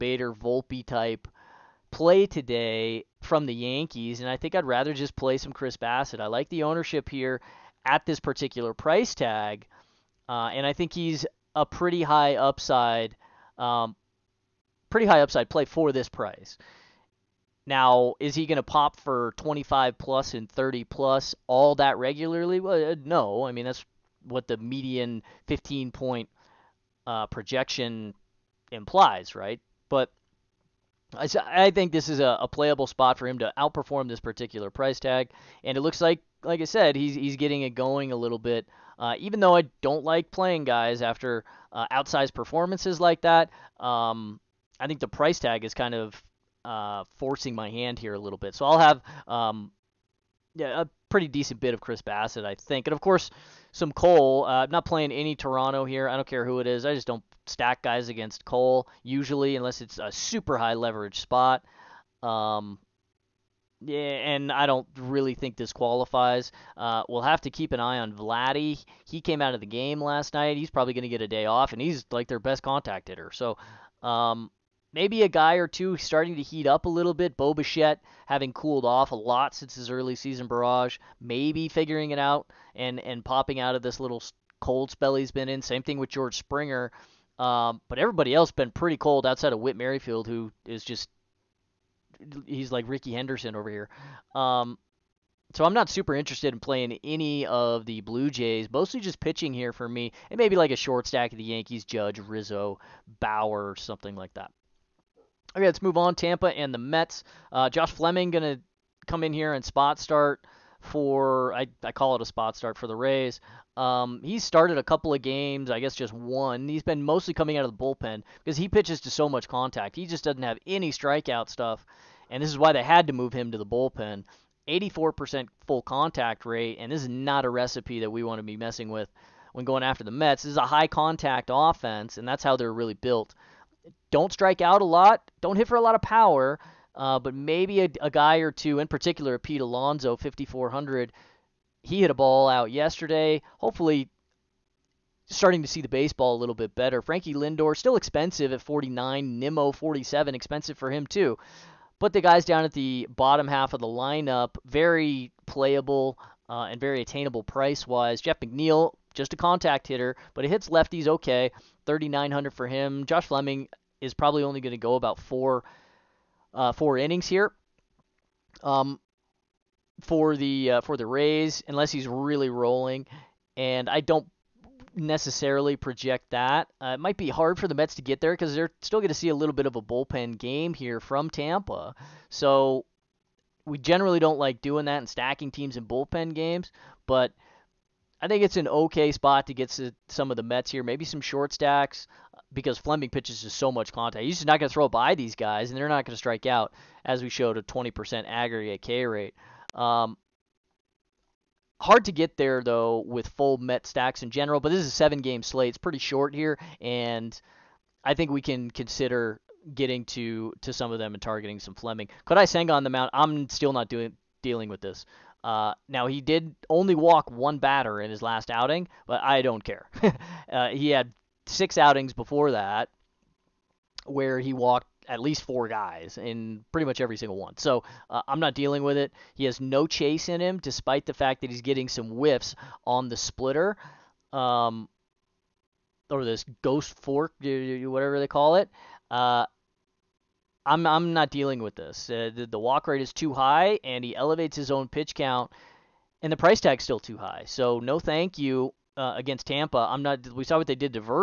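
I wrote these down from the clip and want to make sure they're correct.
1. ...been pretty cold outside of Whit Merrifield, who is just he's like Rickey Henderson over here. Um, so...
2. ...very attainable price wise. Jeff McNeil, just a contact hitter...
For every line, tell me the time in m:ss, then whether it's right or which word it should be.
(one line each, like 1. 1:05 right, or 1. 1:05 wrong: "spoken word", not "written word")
1. 1:28 right
2. 2:36 right.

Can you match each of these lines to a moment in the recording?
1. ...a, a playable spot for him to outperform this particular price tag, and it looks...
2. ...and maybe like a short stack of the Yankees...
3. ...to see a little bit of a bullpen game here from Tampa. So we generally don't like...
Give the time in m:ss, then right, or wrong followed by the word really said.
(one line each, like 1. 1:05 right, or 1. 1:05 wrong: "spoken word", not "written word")
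1. 0:32 right
2. 1:40 right
3. 2:59 right.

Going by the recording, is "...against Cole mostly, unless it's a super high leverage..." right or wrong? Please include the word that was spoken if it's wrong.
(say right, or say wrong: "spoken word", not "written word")
wrong: "usually", not "mostly".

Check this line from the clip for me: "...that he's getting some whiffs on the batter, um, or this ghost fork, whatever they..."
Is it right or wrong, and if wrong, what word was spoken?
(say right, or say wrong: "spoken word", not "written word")
wrong: "splitter", not "batter".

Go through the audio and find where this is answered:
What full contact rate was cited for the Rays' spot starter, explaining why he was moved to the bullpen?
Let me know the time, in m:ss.
2:04.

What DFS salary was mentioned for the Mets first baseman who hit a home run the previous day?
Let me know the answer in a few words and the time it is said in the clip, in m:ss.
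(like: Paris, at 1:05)
5400, at 2:20.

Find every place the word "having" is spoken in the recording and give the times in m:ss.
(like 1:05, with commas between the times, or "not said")
1:18.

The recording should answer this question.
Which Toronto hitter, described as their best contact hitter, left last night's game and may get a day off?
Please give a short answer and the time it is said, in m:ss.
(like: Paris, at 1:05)
Vladdy, at 1:08.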